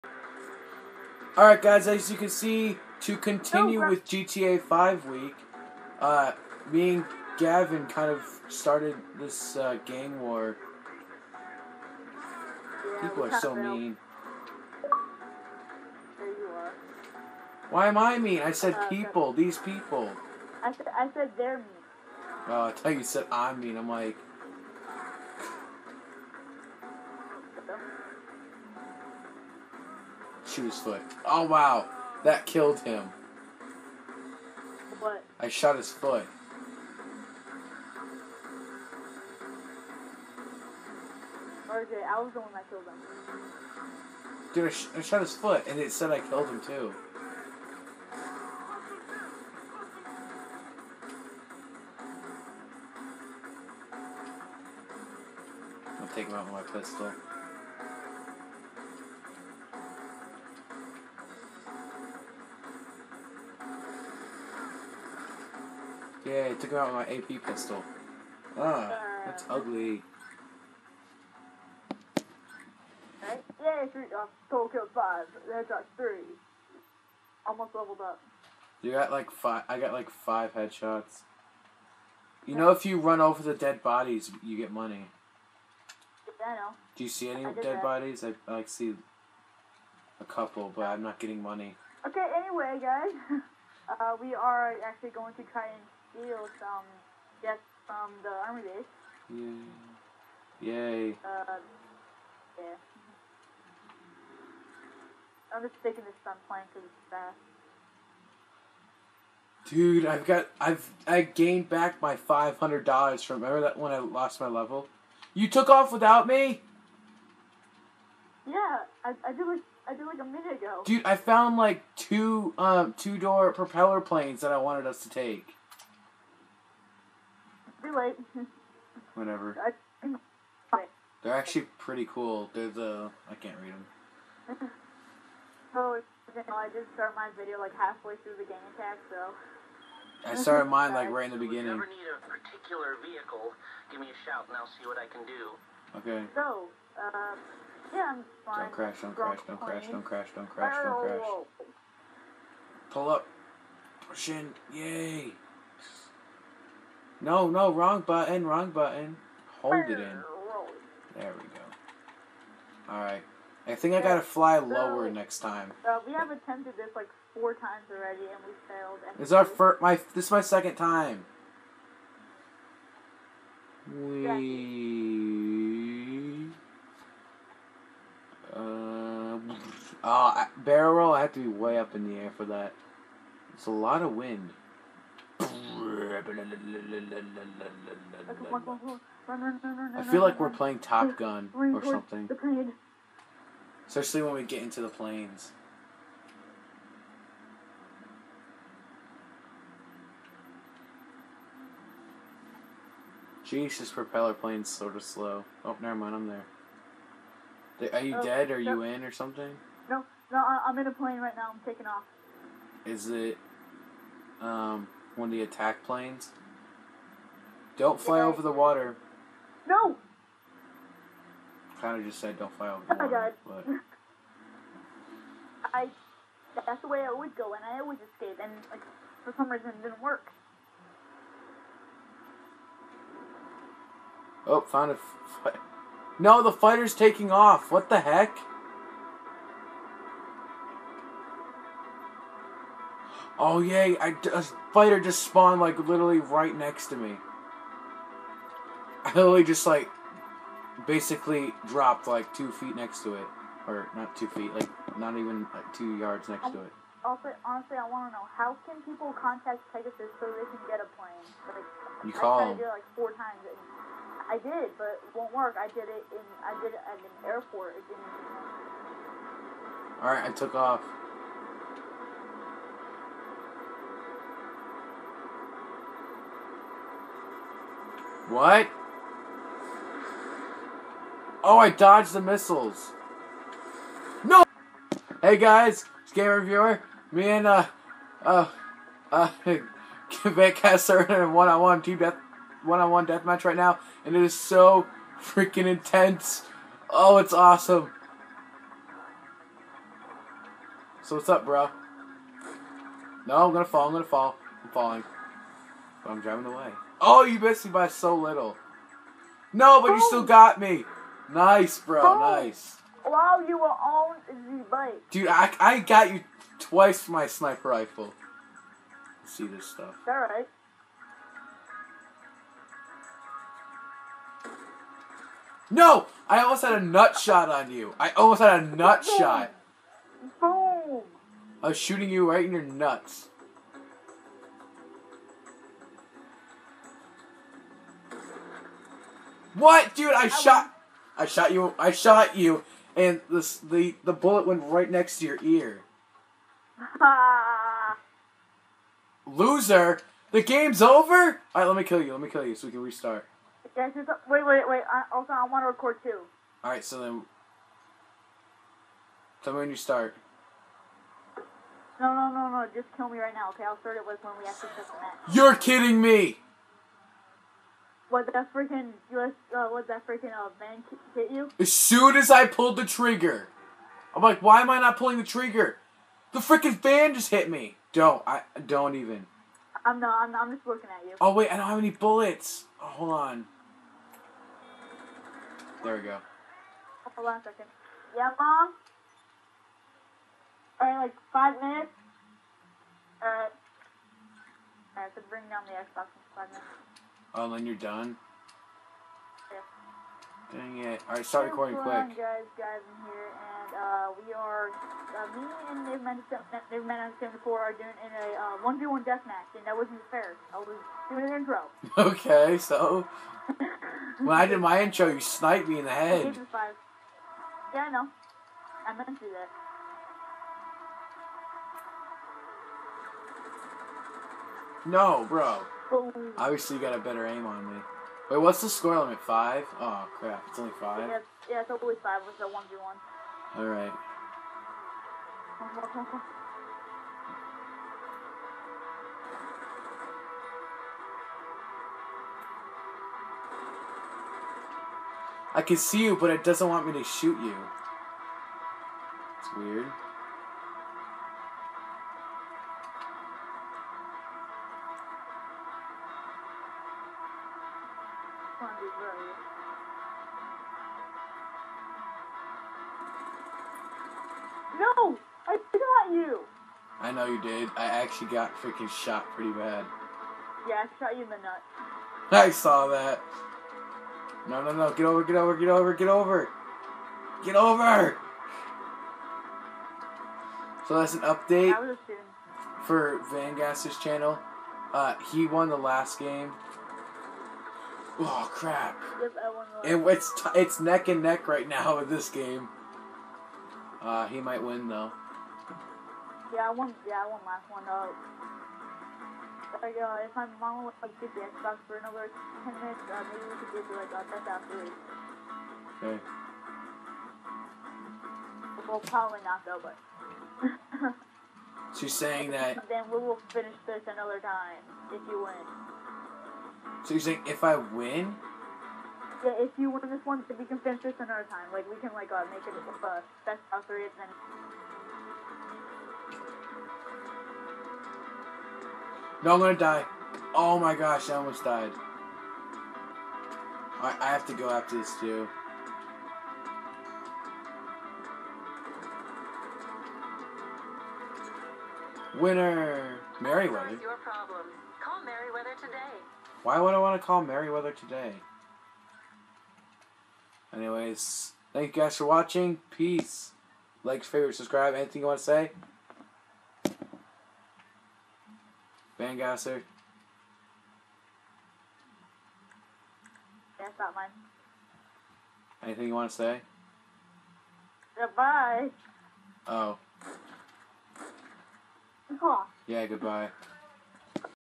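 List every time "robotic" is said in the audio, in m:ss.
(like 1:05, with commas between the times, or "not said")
not said.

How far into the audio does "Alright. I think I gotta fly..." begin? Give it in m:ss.
2:42.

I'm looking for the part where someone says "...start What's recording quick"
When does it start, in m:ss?
6:41.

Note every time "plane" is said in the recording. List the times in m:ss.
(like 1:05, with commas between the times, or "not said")
1:46, 2:04, 3:14, 3:24, 3:30, 3:35, 4:20.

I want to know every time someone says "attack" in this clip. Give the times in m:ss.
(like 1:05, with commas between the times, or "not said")
2:18, 3:35.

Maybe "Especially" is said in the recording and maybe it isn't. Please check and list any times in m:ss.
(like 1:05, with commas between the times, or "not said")
3:13.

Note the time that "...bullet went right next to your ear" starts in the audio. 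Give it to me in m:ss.
5:44.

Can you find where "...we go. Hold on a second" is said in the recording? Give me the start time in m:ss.
6:25.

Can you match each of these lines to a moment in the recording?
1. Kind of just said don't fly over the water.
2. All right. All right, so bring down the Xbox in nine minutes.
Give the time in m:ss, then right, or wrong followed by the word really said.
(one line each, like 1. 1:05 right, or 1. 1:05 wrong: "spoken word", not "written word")
1. 3:41 right
2. 6:33 wrong: "five", not "nine".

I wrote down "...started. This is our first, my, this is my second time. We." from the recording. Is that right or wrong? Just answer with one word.
wrong.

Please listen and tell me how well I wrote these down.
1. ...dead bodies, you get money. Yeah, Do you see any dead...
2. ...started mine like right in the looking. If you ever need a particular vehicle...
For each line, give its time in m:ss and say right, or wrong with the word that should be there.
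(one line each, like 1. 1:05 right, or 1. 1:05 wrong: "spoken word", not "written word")
1. 1:23 right
2. 2:20 wrong: "beginning", not "looking".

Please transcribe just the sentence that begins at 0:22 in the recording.
Oh, I thought you said I'm mean.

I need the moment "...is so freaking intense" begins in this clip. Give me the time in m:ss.
4:54.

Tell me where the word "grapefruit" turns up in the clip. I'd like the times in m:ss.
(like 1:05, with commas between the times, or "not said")
not said.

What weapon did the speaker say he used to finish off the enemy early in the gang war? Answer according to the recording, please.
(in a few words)
AP pistol.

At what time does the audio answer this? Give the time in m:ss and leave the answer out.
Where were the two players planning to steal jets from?
1:38.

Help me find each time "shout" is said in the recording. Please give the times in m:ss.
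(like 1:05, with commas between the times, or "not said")
2:24.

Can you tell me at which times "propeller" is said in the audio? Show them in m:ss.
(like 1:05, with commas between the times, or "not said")
2:03, 3:23.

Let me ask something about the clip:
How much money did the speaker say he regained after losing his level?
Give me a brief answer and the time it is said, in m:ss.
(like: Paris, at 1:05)
$500, at 1:52.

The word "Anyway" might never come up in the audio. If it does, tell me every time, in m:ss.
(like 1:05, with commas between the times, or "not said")
1:32, 9:10.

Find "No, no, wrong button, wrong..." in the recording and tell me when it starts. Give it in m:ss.
2:37.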